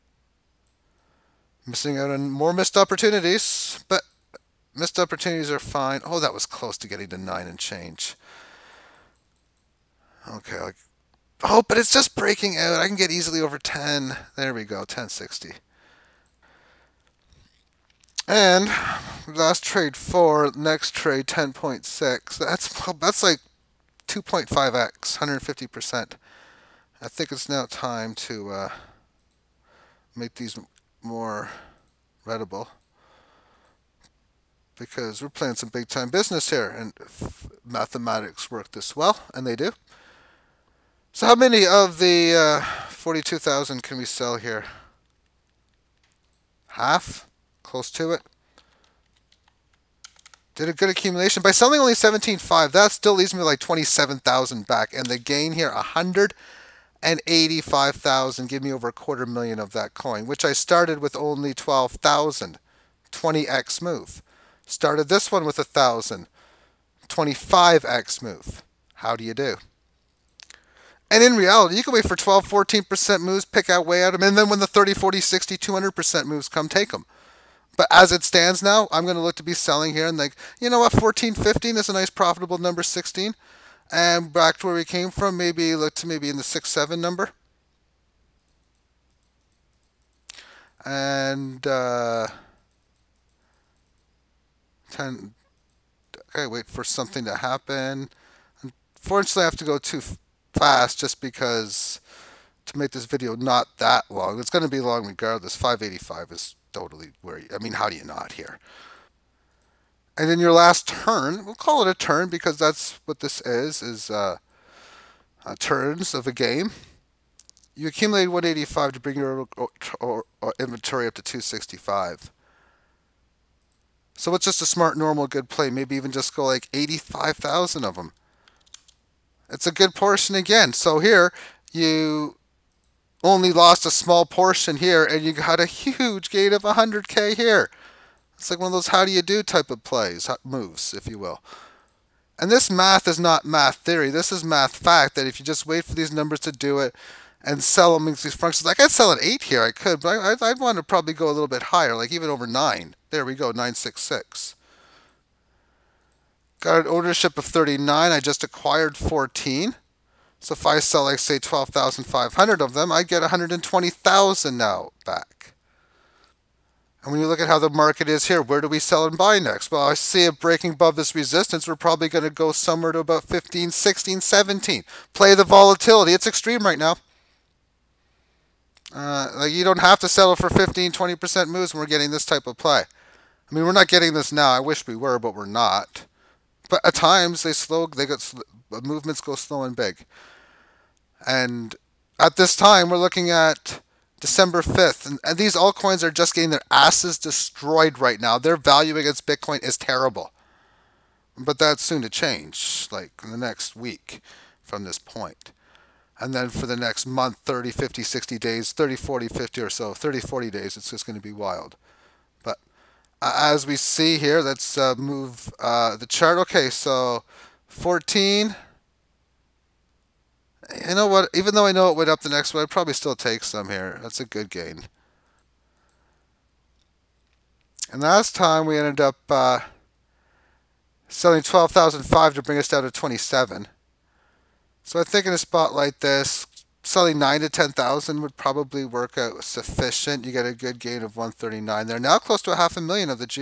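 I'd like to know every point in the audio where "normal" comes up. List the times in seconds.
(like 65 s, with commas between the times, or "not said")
124 s.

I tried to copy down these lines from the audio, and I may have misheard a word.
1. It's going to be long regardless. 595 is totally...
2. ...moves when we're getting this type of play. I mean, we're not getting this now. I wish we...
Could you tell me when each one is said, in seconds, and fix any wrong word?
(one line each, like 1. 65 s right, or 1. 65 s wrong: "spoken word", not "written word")
1. 104 s wrong: "585", not "595"
2. 181 s right.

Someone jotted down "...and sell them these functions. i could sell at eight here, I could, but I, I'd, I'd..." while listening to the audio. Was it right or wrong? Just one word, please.
right.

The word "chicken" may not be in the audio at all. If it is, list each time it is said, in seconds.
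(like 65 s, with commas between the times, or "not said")
not said.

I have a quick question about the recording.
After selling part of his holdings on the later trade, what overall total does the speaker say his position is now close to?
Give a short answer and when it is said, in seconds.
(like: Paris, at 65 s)
half a million, at 242 s.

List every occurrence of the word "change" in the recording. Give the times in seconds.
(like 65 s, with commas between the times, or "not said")
7 s, 202 s.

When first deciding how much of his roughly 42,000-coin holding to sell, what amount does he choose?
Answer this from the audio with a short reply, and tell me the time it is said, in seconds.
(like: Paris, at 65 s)
17.5, at 51 s.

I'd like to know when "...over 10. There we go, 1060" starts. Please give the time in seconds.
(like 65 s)
13 s.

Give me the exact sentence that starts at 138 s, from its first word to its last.
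It's like one of those how do you do type of plays, moves, if you will.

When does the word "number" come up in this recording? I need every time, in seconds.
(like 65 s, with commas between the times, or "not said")
82 s, 86 s, 146 s.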